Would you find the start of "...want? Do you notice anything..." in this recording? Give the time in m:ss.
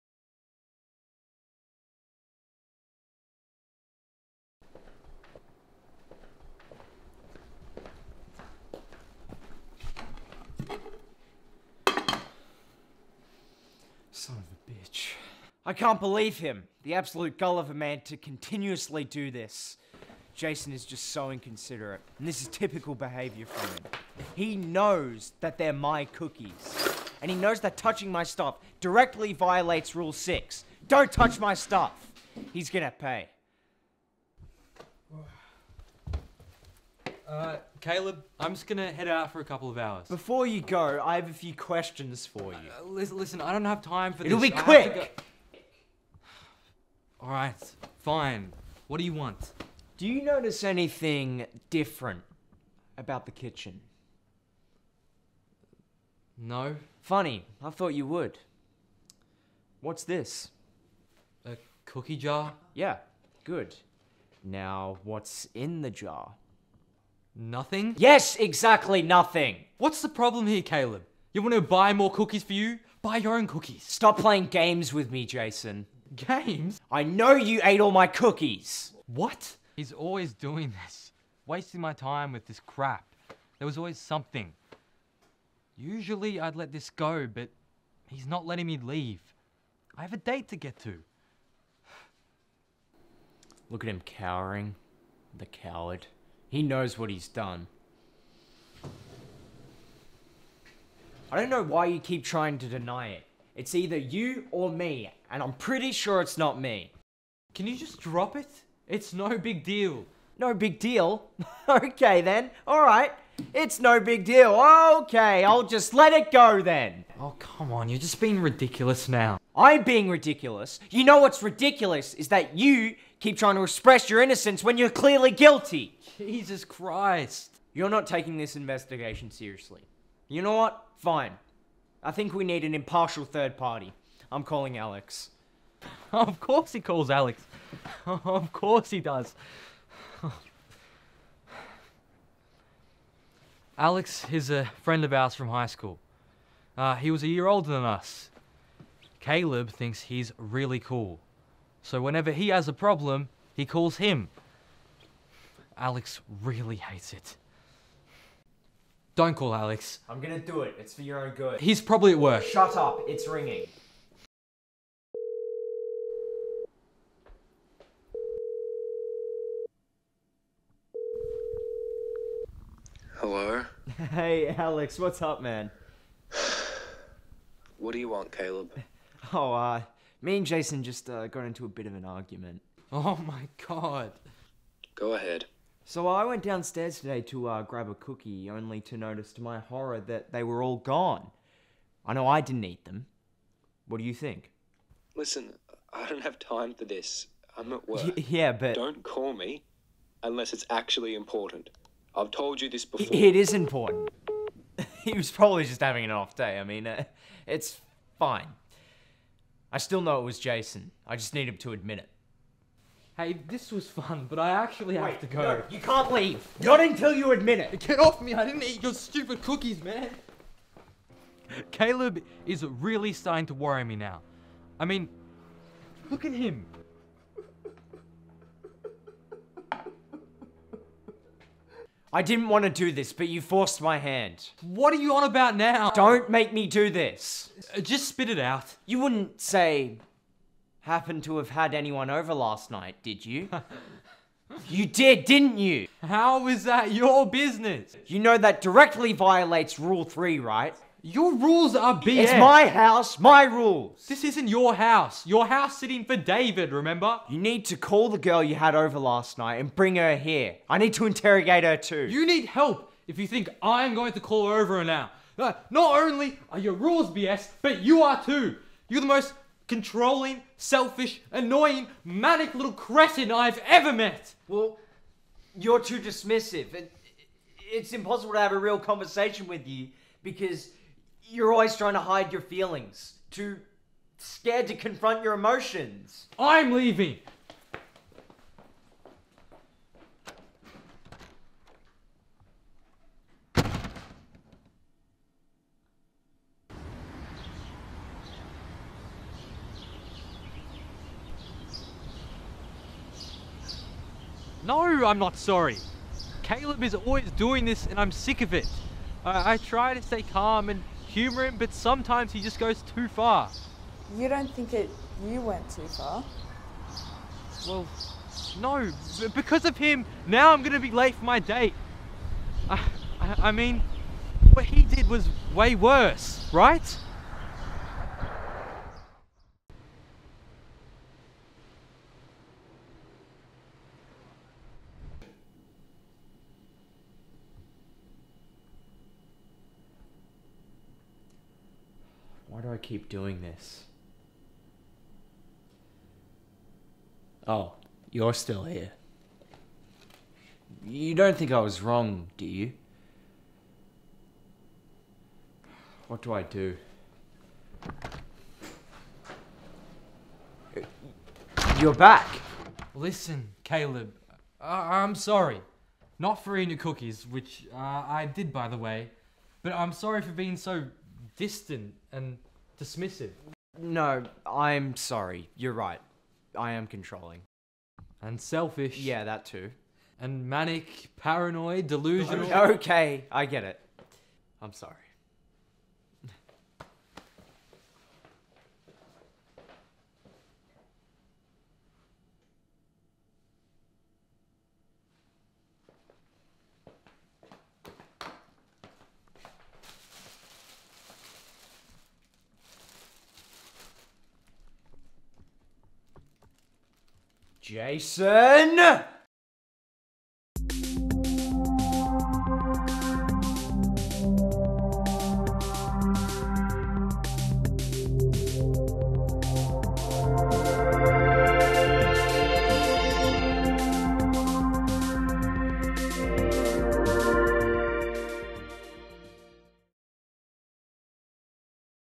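0:49.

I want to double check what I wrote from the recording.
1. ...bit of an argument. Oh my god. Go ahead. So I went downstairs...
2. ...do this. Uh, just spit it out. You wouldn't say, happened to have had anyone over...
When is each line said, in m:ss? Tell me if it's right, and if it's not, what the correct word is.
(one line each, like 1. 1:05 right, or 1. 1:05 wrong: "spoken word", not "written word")
1. 3:01 right
2. 3:56 right.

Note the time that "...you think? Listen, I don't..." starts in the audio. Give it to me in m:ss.
3:14.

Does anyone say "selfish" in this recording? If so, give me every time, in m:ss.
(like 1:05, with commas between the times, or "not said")
4:30, 6:18.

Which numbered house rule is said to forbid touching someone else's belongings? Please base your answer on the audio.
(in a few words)
Rule 6.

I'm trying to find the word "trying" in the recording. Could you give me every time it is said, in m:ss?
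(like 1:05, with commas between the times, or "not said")
1:42, 2:03, 4:41.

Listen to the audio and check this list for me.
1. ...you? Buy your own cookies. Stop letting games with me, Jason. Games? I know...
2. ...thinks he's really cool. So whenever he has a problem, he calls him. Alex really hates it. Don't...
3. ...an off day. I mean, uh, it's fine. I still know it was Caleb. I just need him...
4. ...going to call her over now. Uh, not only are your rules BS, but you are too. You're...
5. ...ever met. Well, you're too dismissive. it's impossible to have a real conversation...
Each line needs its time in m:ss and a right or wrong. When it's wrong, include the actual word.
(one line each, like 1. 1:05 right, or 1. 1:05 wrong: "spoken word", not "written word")
1. 1:12 wrong: "playing", not "letting"
2. 2:29 right
3. 3:26 wrong: "Jason", not "Caleb"
4. 4:23 right
5. 4:33 right.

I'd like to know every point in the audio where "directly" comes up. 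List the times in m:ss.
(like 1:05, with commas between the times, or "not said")
0:28, 4:08.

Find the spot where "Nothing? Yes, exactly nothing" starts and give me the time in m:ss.
1:07.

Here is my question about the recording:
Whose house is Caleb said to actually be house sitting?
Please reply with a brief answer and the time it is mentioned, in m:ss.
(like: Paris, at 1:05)
David's, at 4:16.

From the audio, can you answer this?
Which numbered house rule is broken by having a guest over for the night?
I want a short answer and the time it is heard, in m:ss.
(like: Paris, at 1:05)
Rule 3, at 4:09.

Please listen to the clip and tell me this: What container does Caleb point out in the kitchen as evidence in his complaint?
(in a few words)
A cookie jar.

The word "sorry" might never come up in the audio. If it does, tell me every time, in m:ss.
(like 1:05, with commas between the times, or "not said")
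5:05, 6:05, 6:09, 6:14, 6:24.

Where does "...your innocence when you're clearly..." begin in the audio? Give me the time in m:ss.
2:04.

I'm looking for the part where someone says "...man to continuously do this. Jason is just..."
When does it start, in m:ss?
0:17.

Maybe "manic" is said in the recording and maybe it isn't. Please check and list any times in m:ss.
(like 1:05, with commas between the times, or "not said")
4:32, 6:20.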